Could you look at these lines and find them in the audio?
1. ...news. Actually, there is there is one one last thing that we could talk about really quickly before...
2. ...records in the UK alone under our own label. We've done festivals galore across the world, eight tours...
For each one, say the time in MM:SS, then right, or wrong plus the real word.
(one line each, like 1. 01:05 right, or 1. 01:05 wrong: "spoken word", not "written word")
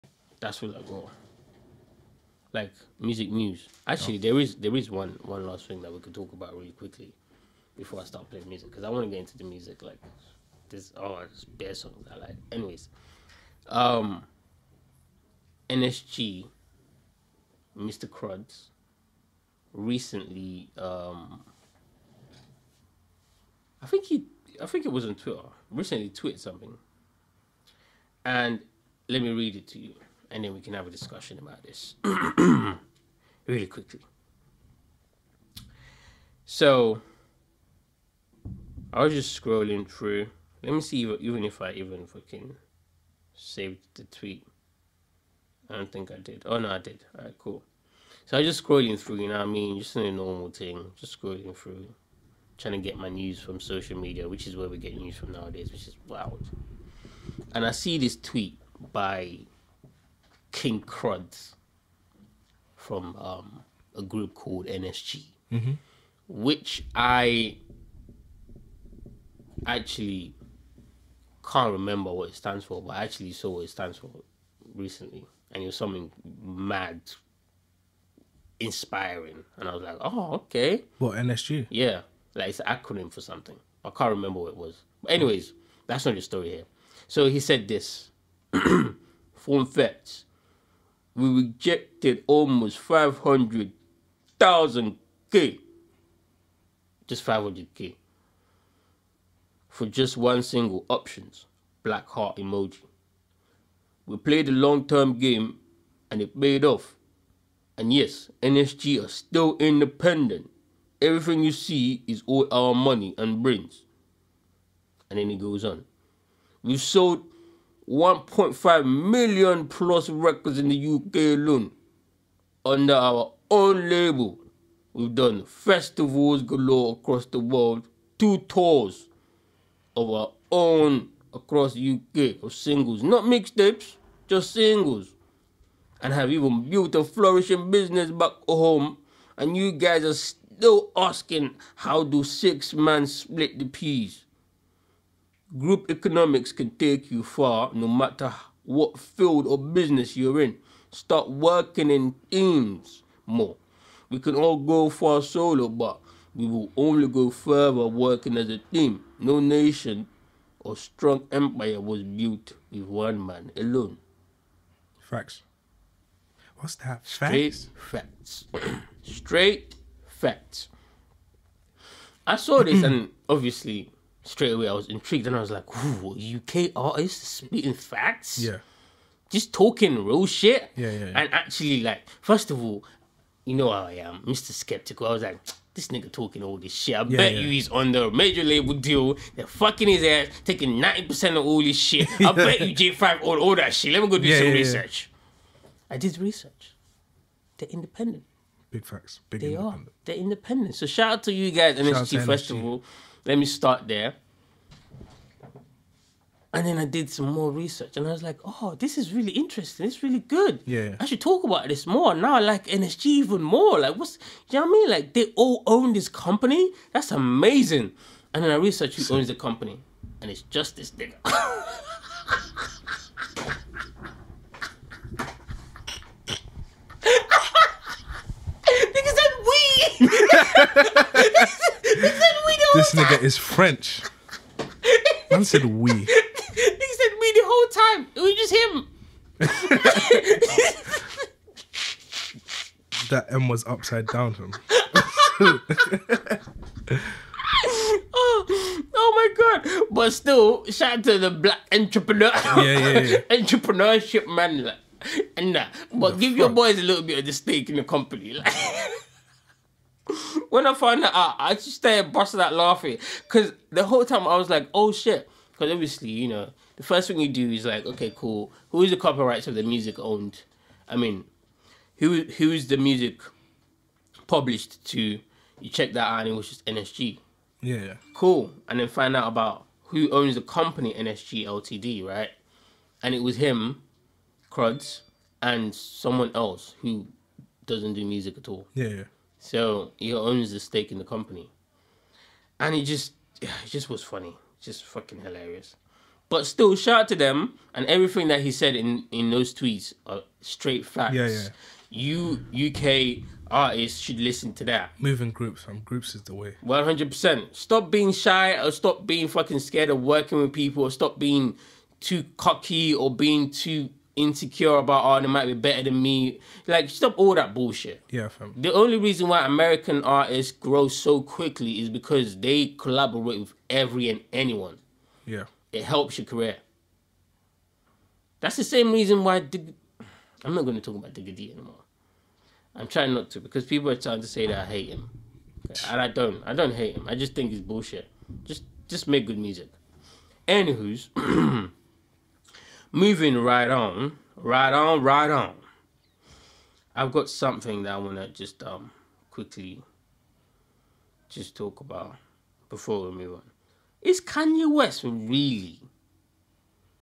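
1. 00:03 right
2. 02:00 wrong: "two", not "eight".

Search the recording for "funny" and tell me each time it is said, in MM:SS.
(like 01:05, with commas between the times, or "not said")
04:54.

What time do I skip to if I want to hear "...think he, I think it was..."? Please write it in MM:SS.
00:23.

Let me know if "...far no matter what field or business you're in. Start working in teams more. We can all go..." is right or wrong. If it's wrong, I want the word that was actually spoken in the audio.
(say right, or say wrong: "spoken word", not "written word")
right.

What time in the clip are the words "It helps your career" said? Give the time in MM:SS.
05:25.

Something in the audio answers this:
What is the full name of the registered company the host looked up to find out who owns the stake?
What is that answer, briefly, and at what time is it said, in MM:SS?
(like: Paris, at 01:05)
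NSG Ltd, at 04:40.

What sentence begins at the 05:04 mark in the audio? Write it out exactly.
Moving groups, from groups is the way.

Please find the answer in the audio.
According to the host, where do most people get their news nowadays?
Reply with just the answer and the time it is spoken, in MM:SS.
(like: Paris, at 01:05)
Social media, at 00:53.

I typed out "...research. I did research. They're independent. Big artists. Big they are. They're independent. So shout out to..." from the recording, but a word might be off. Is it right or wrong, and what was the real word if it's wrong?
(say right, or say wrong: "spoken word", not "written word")
wrong: "facts", not "artists".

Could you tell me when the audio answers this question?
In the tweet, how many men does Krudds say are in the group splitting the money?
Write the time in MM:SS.
02:22.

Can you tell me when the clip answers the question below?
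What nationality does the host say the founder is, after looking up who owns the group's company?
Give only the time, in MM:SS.
03:53.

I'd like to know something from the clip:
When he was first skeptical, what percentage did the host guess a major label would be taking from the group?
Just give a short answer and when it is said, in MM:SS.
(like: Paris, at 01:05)
90%, at 03:10.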